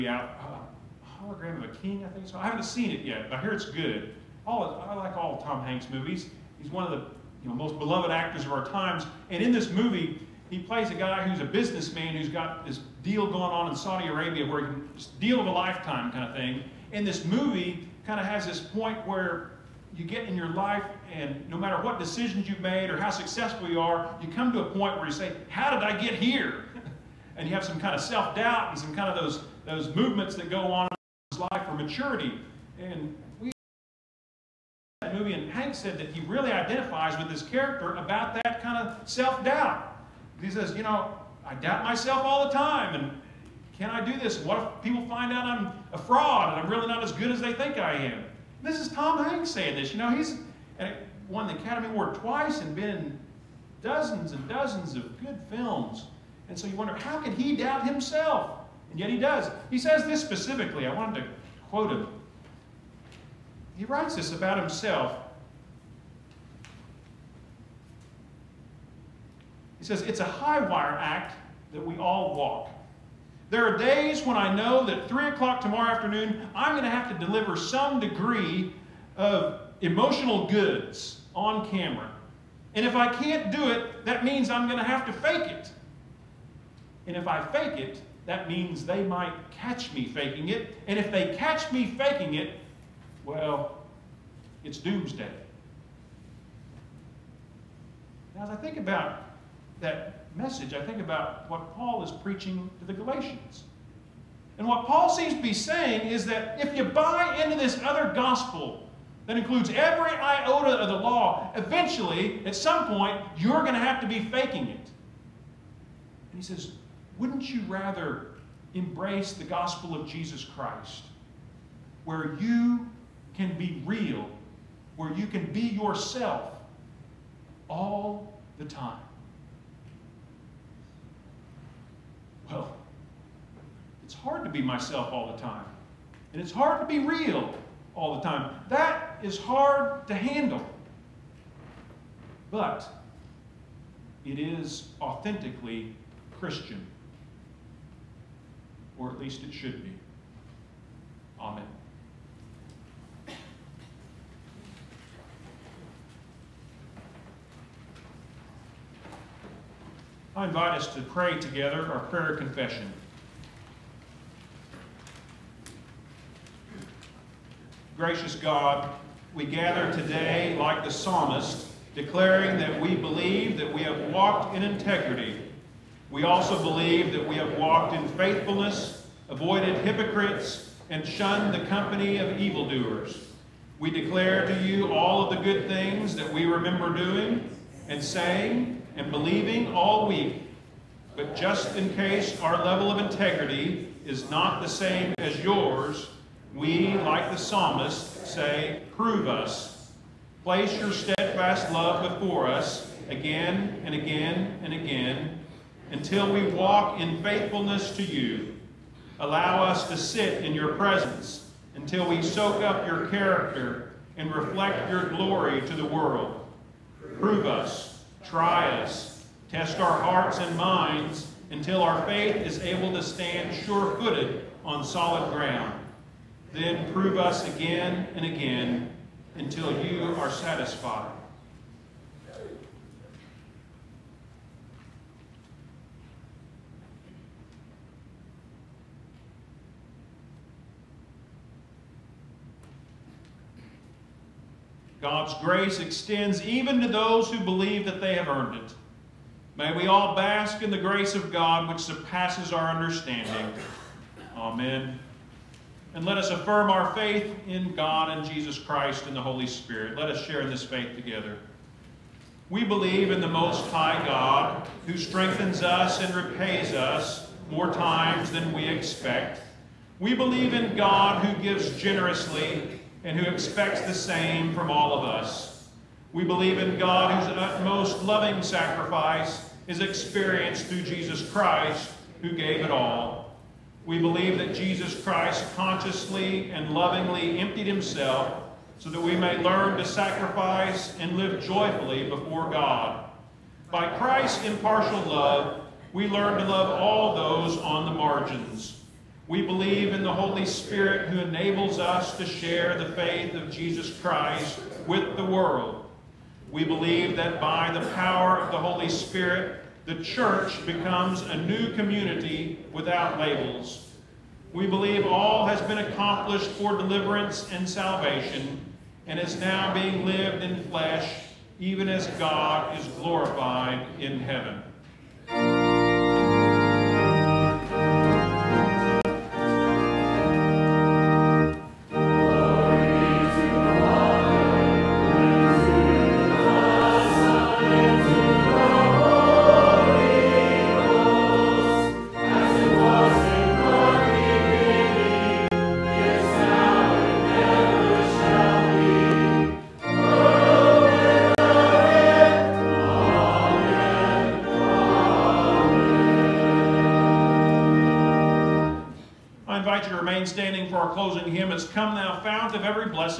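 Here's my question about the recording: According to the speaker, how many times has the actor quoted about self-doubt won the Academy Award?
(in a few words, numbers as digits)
twice.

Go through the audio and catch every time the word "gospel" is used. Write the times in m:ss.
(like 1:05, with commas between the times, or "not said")
1:48, 1:59.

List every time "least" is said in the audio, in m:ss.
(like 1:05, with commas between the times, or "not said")
2:29.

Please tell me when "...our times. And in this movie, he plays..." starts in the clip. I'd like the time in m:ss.
0:08.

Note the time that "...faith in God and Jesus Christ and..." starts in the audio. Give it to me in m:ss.
4:16.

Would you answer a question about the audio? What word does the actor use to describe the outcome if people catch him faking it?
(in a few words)
doomsday.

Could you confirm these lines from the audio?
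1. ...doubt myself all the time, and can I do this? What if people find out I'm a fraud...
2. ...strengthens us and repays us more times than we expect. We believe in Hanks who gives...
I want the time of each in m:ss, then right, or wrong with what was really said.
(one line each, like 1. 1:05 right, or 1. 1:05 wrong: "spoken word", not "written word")
1. 0:41 right
2. 4:24 wrong: "God", not "Hanks".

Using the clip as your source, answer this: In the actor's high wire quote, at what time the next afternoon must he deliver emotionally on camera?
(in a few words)
3 o'clock.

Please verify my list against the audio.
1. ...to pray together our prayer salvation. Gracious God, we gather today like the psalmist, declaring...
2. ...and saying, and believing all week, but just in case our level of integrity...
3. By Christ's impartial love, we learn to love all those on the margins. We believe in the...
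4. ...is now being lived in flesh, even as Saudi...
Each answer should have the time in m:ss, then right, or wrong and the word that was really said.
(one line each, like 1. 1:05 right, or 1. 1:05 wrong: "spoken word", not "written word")
1. 2:40 wrong: "confession", not "salvation"
2. 3:07 right
3. 4:53 right
4. 5:19 wrong: "God", not "Saudi".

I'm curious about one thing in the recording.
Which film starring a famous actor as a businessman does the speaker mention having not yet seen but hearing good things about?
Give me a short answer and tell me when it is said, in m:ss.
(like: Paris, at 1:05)
Hologram of a King, at 0:01.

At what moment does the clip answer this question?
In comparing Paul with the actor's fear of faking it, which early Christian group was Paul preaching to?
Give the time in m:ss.
1:42.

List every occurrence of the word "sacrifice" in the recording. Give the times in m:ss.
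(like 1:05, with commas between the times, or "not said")
4:38, 4:49.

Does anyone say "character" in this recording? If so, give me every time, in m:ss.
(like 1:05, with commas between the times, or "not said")
0:37, 3:33.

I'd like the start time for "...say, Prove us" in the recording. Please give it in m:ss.
3:18.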